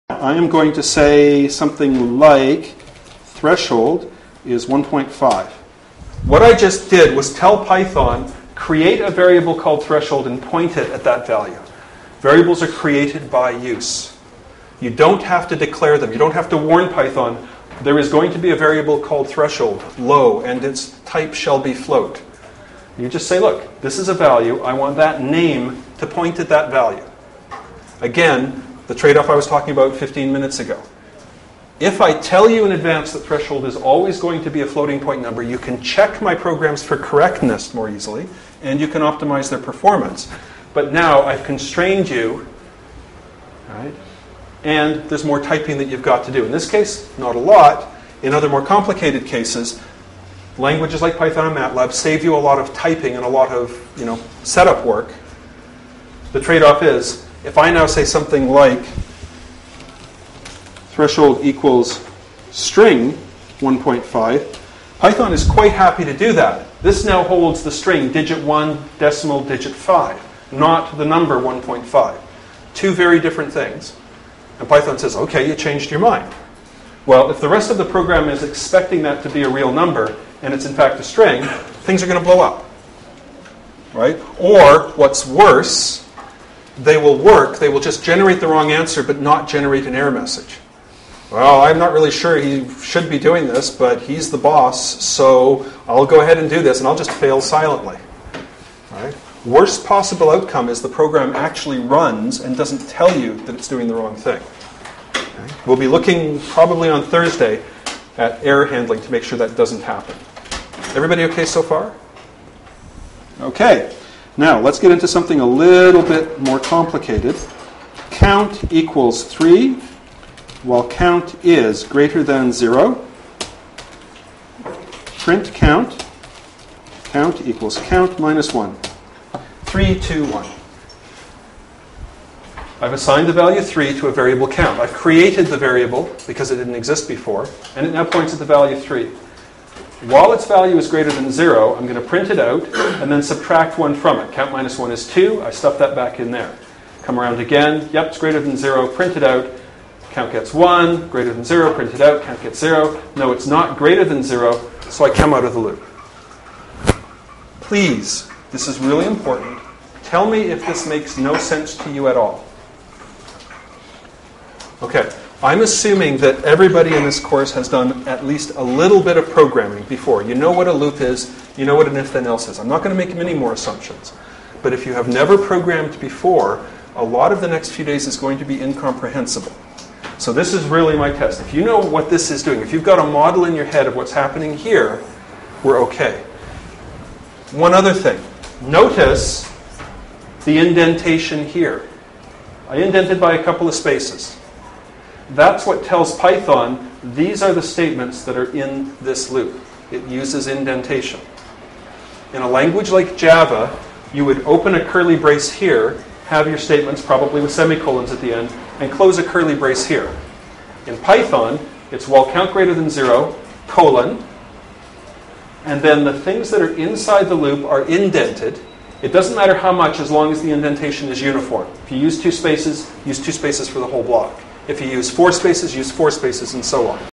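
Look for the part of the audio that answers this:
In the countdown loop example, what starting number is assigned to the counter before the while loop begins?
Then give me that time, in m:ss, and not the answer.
1:58.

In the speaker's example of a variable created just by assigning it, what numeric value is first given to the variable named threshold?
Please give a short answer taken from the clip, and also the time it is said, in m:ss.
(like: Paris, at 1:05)
1.5, at 0:03.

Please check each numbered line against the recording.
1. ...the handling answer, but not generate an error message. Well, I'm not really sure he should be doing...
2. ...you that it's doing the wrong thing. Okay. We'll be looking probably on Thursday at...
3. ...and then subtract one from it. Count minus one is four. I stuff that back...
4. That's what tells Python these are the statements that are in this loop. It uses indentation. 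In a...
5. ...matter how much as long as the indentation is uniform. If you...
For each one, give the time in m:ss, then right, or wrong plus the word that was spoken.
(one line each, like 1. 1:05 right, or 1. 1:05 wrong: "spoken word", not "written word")
1. 1:28 wrong: "wrong", not "handling"
2. 1:43 right
3. 2:23 wrong: "two", not "four"
4. 3:15 right
5. 3:39 right.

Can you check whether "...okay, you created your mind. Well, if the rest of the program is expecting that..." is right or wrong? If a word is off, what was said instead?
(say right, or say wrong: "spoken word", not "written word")
wrong: "changed", not "created".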